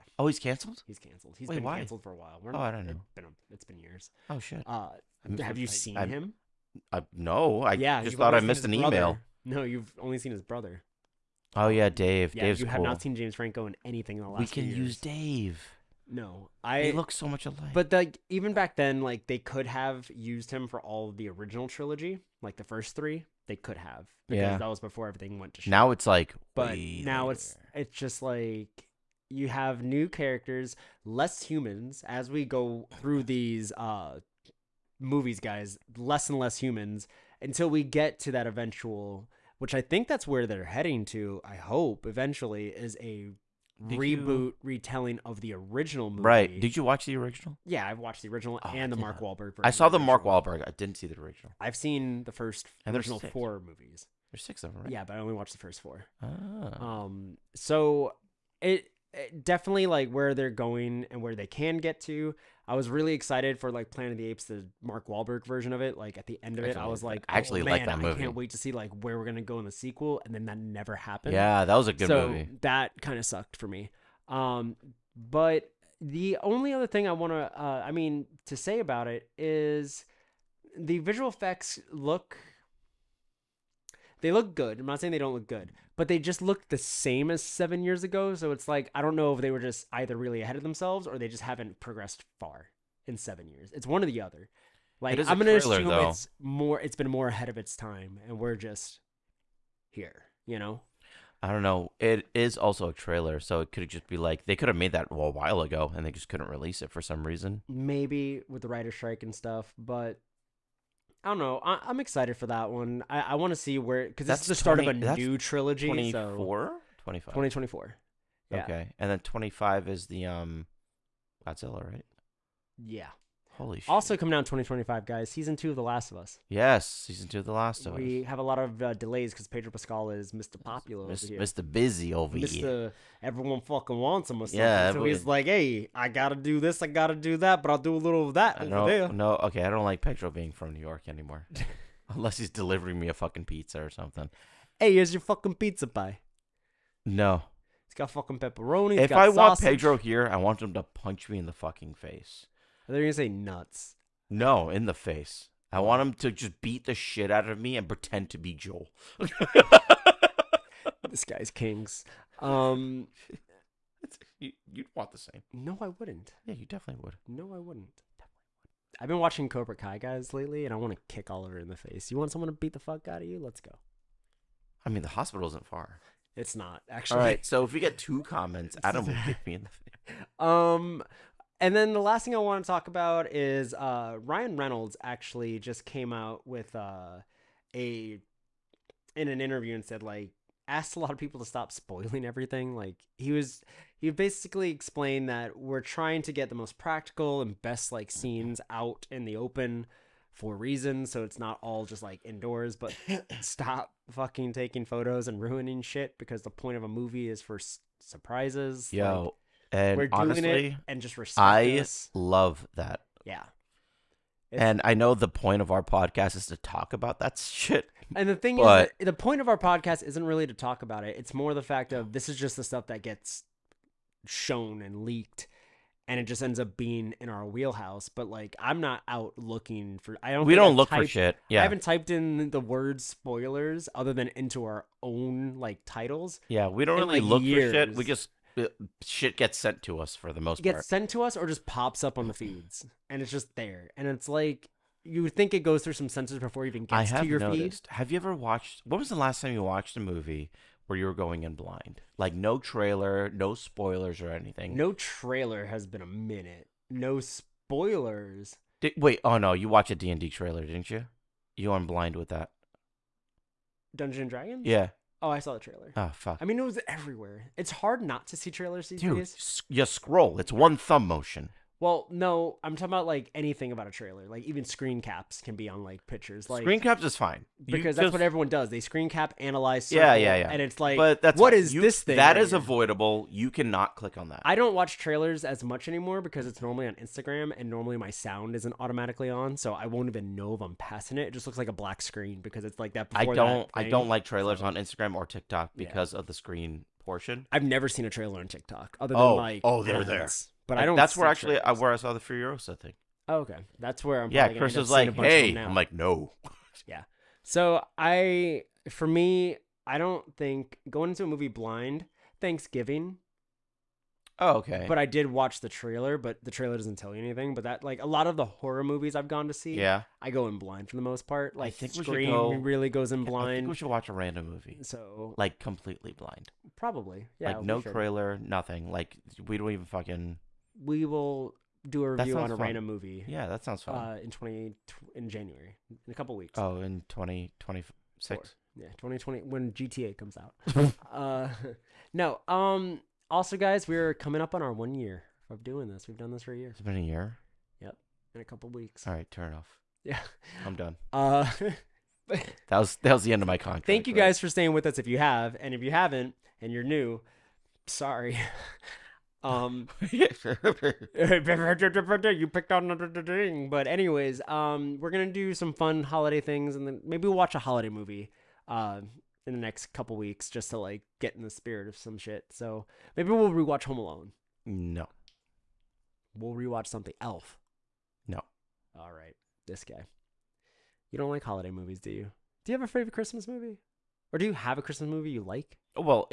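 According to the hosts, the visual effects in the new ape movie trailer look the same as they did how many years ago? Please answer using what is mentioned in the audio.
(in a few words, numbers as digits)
7.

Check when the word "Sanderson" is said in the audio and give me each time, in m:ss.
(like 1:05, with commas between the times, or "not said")
not said.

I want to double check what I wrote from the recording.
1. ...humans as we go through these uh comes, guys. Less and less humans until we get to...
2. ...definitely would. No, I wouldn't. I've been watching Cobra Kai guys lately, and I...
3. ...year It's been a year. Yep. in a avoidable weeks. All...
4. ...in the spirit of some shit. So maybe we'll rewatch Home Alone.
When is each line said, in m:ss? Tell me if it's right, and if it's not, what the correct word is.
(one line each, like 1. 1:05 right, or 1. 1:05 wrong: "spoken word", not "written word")
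1. 0:31 wrong: "movies", not "comes"
2. 2:46 right
3. 5:46 wrong: "couple", not "avoidable"
4. 6:11 right.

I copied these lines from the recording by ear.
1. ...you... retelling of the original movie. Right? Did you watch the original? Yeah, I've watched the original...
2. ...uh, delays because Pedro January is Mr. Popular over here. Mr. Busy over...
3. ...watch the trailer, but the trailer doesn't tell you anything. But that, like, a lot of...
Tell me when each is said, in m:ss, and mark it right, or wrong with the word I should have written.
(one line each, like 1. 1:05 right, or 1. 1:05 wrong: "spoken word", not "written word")
1. 0:44 right
2. 2:08 wrong: "Pascal", not "January"
3. 5:15 right.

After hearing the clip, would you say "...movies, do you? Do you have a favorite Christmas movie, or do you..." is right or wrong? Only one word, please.
right.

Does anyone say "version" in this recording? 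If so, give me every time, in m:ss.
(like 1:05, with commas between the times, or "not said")
1:05.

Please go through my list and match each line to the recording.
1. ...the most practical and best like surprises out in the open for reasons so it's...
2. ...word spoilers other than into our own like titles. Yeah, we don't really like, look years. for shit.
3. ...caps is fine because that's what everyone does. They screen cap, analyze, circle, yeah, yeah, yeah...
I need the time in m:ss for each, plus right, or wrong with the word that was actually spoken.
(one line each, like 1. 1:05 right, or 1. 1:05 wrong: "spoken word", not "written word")
1. 3:16 wrong: "scenes", not "surprises"
2. 3:52 right
3. 4:36 right.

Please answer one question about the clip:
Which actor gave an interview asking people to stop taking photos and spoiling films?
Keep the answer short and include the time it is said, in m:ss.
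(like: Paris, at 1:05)
Ryan Reynolds, at 3:04.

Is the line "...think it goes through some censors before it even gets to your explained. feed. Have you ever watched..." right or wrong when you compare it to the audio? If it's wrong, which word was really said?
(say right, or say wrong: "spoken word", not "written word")
wrong: "noticed", not "explained".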